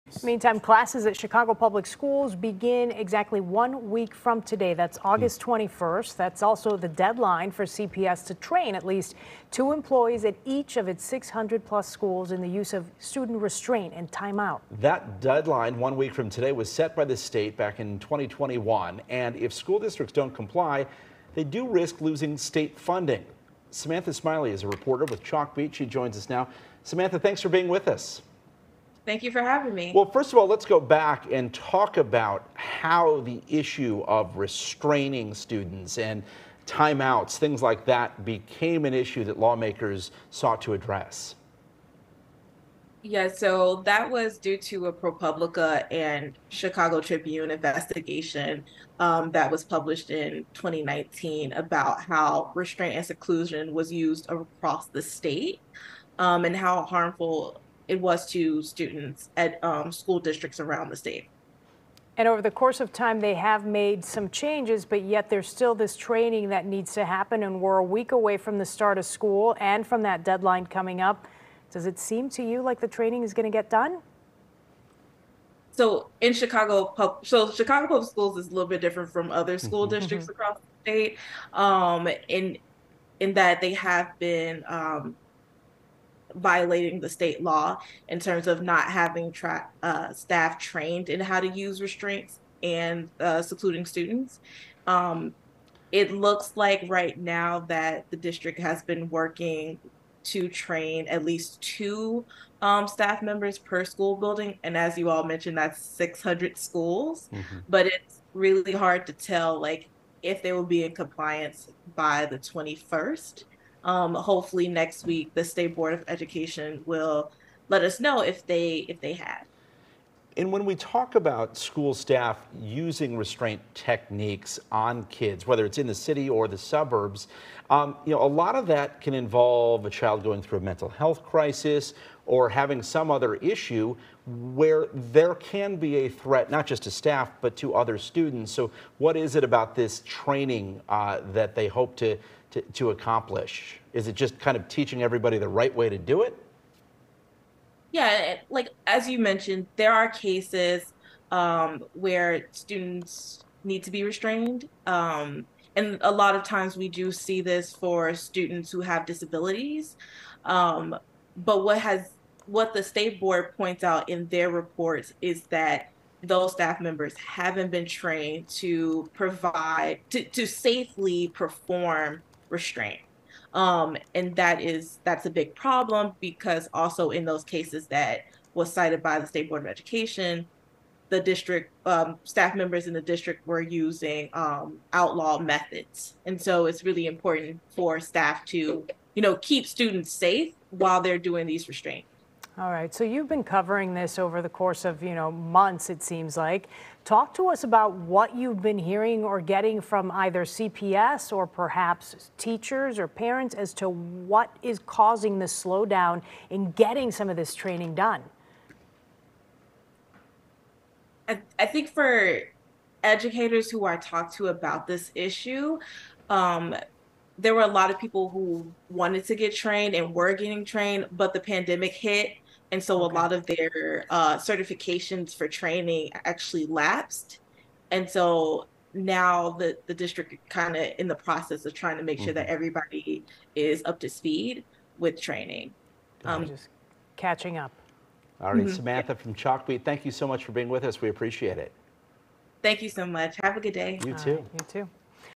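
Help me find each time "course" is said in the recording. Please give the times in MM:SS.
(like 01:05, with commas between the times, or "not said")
01:02, 03:14.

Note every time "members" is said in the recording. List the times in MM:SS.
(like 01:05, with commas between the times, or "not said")
01:43, 02:46, 03:02.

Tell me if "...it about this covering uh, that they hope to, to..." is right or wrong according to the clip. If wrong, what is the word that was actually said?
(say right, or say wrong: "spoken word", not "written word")
wrong: "training", not "covering".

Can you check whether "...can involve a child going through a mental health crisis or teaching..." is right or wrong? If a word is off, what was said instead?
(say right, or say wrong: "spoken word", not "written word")
wrong: "having", not "teaching".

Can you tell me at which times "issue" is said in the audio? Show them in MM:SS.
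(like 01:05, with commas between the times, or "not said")
00:33, 00:38, 02:13, 03:35.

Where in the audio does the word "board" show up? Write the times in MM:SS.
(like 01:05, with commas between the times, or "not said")
01:55, 02:43, 02:59.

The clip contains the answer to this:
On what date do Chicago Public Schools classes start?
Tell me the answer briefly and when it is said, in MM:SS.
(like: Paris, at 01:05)
August 21st, at 00:05.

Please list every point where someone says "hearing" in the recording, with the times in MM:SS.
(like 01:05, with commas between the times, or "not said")
03:18.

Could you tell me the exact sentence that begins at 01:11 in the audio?
Does it seem to you like the training is going to get done?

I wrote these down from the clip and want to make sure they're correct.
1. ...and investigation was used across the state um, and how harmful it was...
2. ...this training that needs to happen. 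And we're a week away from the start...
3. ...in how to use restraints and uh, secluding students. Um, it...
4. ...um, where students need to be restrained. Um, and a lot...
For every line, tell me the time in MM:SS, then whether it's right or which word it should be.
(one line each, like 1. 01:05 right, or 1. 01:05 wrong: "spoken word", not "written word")
1. 00:52 wrong: "seclusion", not "investigation"
2. 01:05 right
3. 01:31 right
4. 02:31 right.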